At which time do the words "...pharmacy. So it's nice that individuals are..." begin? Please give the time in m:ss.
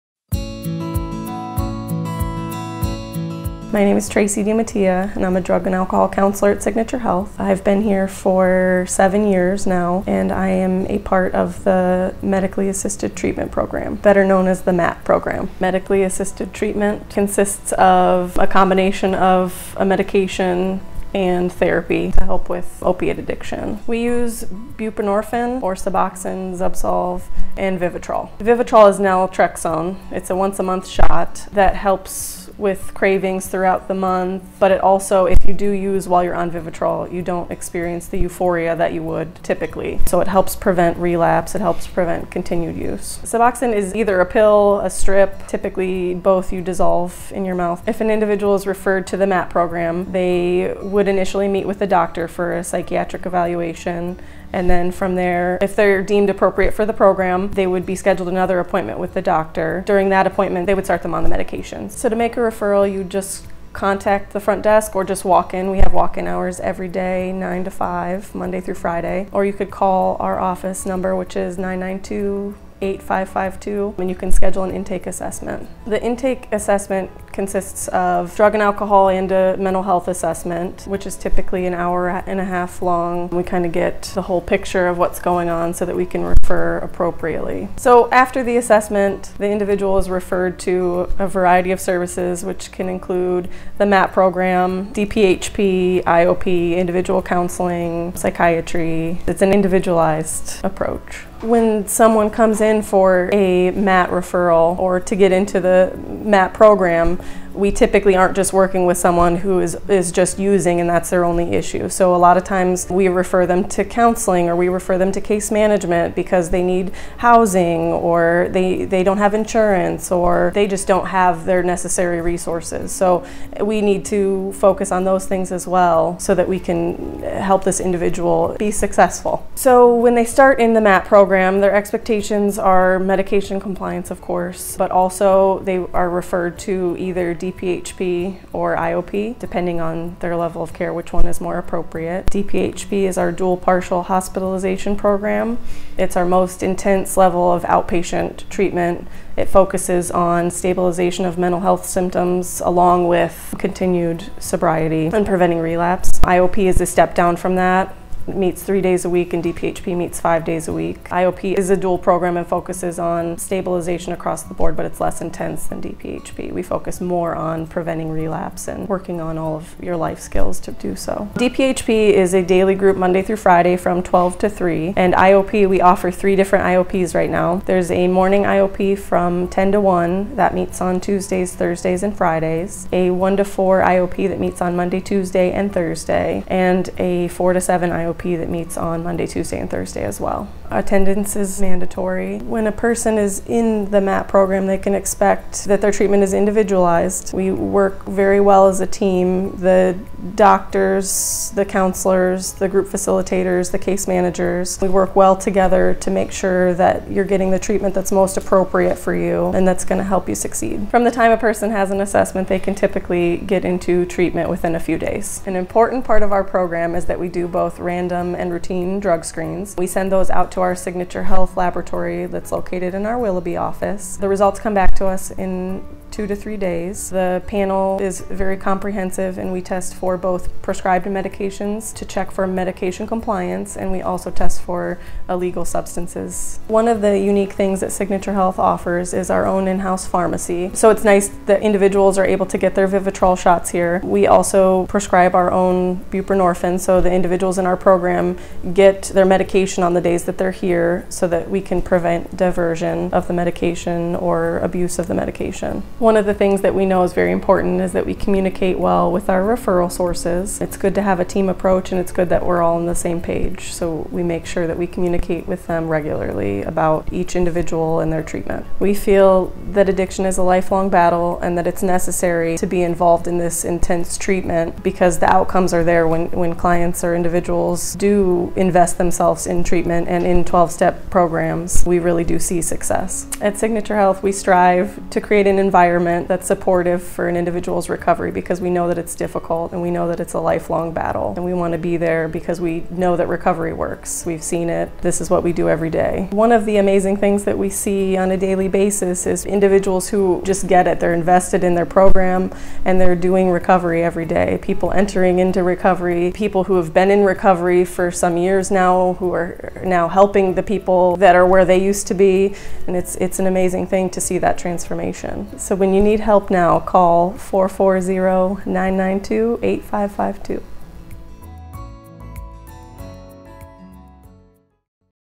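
4:00.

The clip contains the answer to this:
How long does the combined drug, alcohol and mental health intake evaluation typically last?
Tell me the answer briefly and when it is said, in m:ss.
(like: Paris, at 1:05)
an hour and a half, at 1:21.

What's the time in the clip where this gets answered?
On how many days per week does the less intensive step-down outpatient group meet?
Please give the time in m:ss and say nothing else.
2:38.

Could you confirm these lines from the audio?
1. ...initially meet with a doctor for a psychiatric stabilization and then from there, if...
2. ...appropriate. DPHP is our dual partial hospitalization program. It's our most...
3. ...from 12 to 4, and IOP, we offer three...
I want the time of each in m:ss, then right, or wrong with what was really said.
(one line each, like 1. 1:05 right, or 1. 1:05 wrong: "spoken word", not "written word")
1. 0:51 wrong: "evaluation", not "stabilization"
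2. 2:21 right
3. 2:53 wrong: "3", not "4".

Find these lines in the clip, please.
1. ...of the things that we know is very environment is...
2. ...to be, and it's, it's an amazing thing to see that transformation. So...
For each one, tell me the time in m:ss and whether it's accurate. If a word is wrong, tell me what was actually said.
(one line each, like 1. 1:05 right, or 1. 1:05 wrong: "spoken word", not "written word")
1. 4:16 wrong: "important", not "environment"
2. 5:12 right.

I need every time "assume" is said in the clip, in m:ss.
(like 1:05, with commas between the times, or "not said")
not said.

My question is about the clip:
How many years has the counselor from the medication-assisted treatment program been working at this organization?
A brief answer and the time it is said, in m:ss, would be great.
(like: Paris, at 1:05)
7, at 0:08.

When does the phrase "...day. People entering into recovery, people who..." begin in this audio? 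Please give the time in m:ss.
5:04.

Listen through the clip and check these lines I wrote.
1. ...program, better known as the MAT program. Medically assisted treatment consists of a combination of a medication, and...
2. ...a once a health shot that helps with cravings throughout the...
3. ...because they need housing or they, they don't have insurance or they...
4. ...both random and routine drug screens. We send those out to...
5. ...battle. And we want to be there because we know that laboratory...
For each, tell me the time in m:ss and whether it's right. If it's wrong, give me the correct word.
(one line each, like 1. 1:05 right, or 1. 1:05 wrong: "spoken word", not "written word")
1. 0:13 right
2. 0:30 wrong: "month", not "health"
3. 1:56 right
4. 3:37 right
5. 4:50 wrong: "recovery", not "laboratory".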